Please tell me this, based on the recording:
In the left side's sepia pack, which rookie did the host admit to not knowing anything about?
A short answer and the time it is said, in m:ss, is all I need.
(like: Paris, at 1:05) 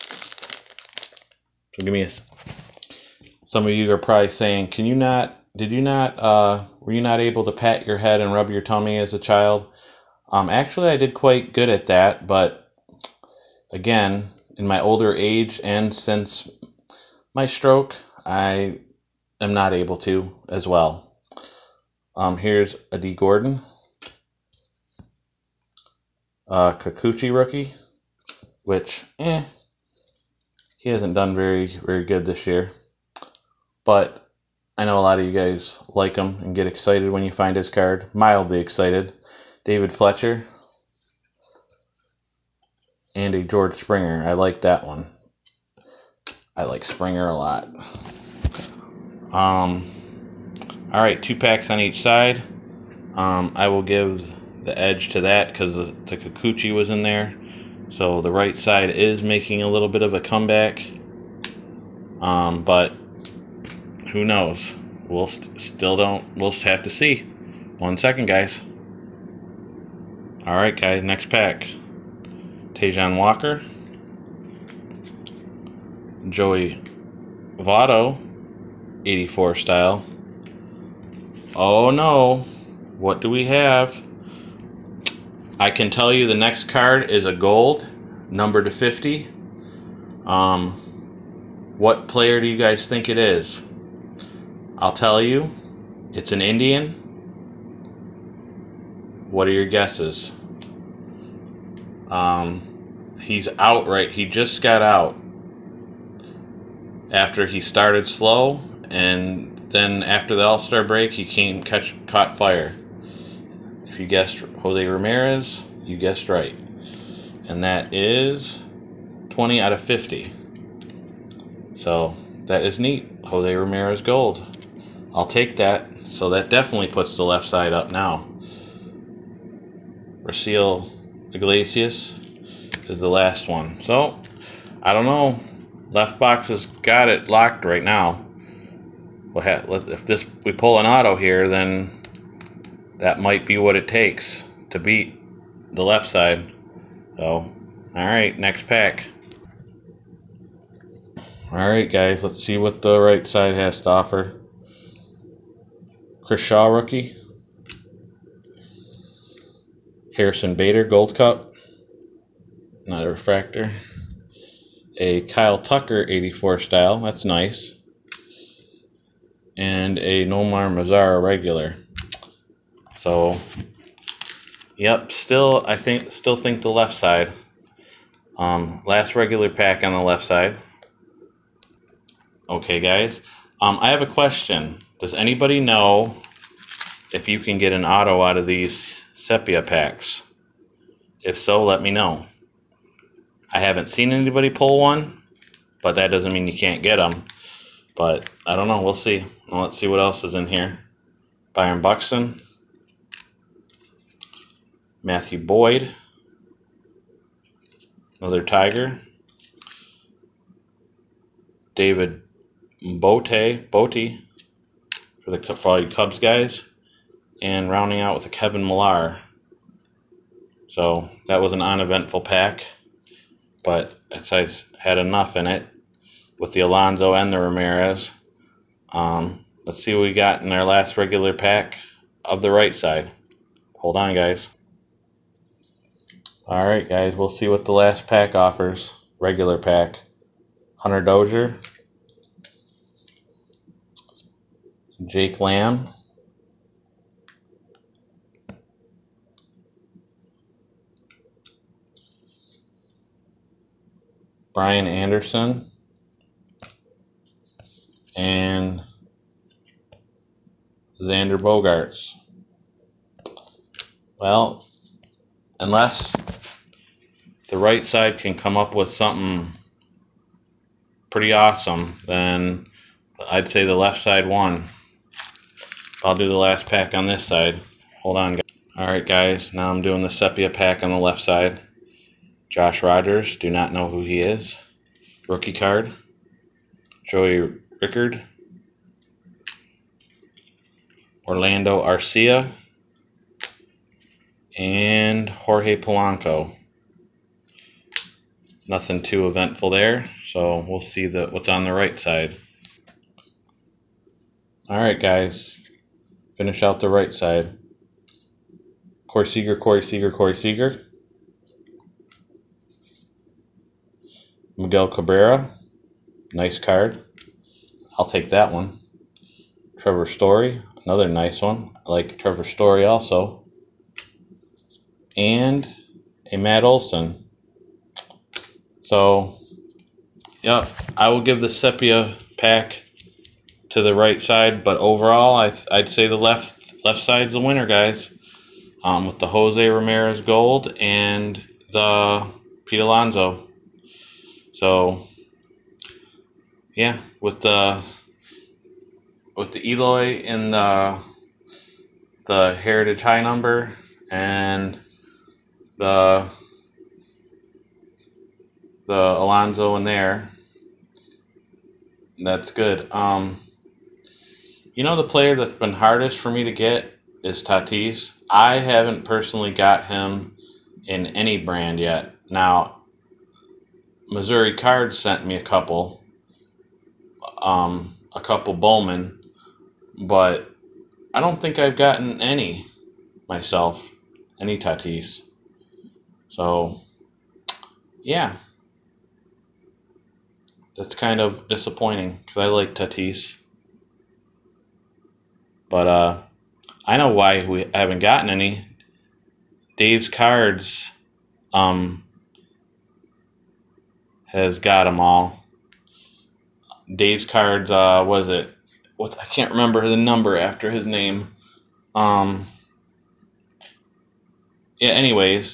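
Josh Rogers, at 4:42.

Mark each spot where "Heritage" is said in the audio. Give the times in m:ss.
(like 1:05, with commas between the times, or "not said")
5:52.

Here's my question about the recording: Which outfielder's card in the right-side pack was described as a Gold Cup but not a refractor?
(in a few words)
Harrison Bader.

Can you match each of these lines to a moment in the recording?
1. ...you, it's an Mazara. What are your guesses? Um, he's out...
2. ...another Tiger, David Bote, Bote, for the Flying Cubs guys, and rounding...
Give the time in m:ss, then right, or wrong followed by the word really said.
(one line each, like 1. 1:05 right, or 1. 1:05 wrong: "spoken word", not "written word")
1. 1:35 wrong: "Indian", not "Mazara"
2. 3:28 right.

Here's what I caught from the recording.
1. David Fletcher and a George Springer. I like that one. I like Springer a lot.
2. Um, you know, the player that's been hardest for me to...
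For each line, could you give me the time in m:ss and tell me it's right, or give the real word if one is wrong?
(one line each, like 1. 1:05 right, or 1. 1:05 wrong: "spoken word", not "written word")
1. 0:39 right
2. 6:02 right.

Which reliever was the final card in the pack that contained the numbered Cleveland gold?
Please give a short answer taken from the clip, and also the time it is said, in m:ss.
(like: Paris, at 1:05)
Raisel Iglesias, at 2:10.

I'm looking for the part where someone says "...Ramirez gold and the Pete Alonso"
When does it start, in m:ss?
5:39.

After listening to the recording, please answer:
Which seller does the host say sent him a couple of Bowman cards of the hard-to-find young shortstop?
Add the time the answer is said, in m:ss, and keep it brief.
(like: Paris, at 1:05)
Missouri Cards, at 6:14.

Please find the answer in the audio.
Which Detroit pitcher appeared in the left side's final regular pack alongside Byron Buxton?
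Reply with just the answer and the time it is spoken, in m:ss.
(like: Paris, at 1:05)
Matthew Boyd, at 3:25.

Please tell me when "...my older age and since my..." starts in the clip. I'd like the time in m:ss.
0:14.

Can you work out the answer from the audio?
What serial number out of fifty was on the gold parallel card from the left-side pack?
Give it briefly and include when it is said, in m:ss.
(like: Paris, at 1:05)
20, at 1:59.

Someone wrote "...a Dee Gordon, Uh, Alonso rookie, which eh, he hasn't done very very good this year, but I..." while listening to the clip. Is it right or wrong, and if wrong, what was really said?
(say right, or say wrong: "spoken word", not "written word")
wrong: "Kikuchi", not "Alonso".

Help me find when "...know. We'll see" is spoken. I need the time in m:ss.
3:18.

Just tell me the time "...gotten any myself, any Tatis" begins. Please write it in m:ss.
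6:21.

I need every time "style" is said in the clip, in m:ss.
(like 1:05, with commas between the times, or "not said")
1:19, 2:46.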